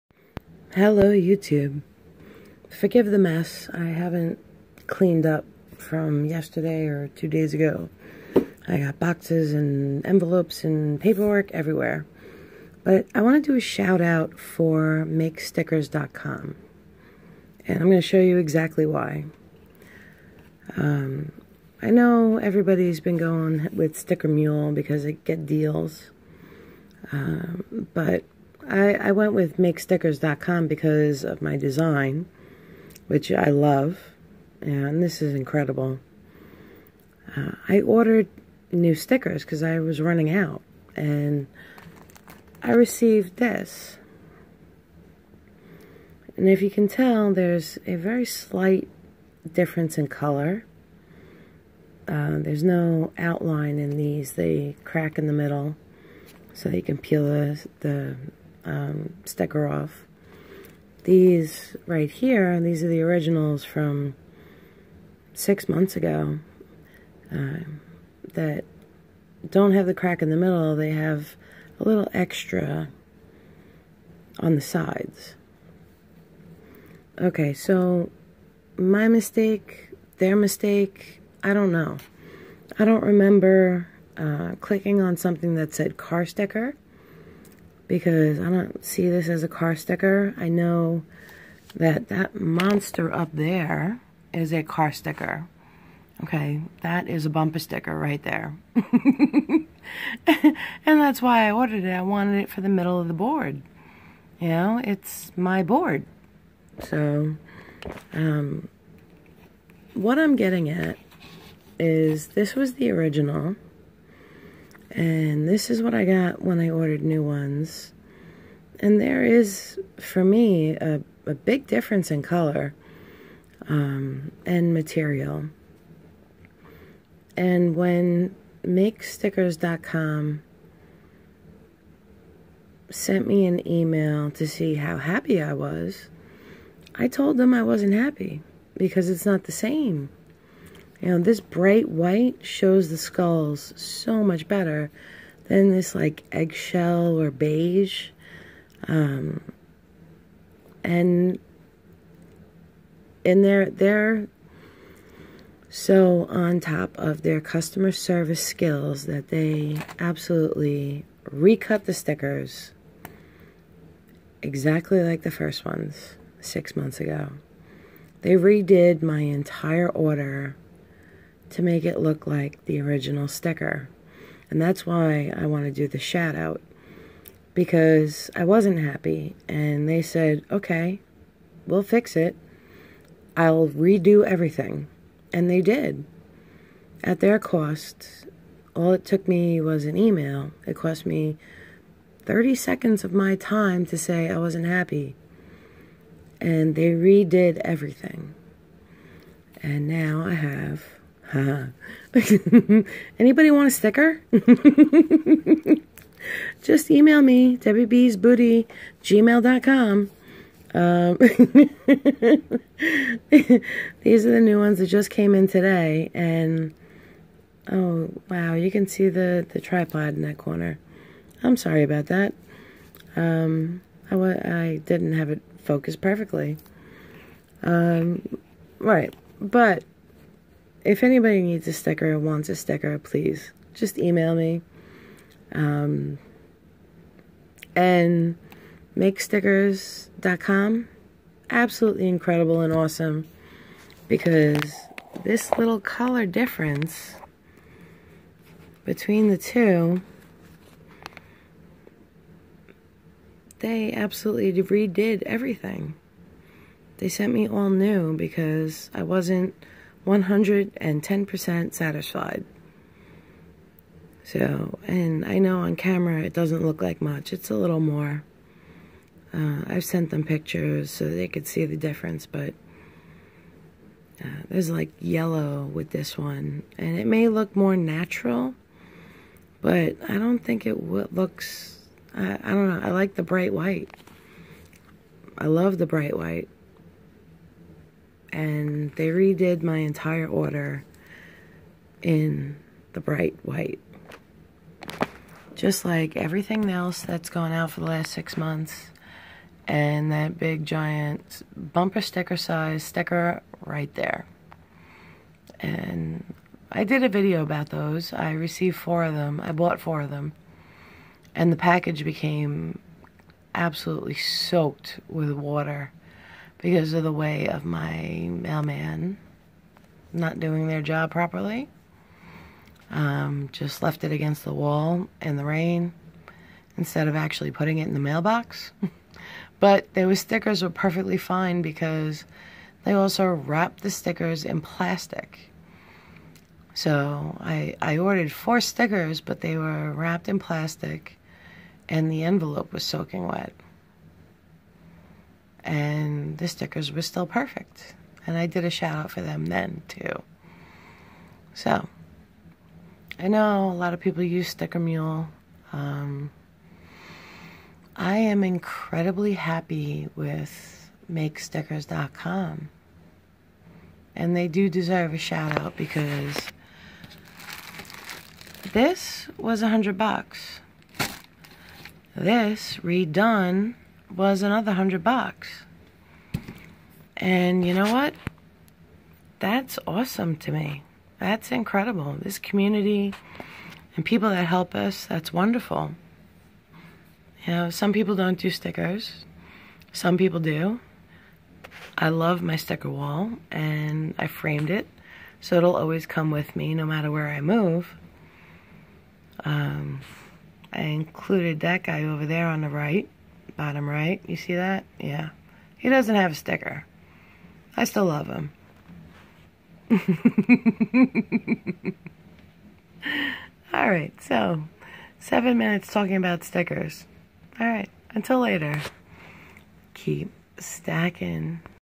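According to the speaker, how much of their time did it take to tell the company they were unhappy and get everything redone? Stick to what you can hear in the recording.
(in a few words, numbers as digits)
30 seconds.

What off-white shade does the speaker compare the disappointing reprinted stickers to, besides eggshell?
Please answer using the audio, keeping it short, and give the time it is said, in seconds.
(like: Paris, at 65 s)
beige, at 147 s.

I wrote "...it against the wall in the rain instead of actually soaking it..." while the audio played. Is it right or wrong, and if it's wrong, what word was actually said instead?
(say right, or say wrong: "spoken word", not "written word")
wrong: "putting", not "soaking".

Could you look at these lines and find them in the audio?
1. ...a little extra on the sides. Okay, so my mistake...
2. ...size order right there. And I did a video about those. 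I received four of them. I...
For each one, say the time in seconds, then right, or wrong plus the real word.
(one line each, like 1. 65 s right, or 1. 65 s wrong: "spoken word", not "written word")
1. 71 s right
2. 302 s wrong: "sticker", not "order".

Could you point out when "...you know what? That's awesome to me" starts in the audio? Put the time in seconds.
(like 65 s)
377 s.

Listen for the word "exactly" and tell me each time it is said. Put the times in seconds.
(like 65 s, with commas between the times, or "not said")
18 s, 164 s.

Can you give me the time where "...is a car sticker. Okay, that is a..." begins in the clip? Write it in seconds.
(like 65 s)
94 s.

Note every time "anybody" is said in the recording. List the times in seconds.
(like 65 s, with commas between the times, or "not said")
201 s, 231 s.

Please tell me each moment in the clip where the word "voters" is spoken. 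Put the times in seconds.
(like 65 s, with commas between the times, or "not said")
not said.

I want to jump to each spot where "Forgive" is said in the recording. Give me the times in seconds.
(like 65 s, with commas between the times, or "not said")
2 s.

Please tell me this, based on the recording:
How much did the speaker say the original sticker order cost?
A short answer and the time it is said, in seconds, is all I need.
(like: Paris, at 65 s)
$100, at 369 s.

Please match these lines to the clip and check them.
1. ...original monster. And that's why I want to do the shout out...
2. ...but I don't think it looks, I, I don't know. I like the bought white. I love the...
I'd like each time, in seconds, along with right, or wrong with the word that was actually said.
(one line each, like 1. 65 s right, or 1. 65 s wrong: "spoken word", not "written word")
1. 172 s wrong: "sticker", not "monster"
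2. 279 s wrong: "bright", not "bought".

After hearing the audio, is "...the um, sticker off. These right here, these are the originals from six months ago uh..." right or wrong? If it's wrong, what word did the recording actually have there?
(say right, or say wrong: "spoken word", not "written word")
right.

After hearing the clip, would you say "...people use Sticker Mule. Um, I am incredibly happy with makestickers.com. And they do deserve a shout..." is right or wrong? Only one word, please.
right.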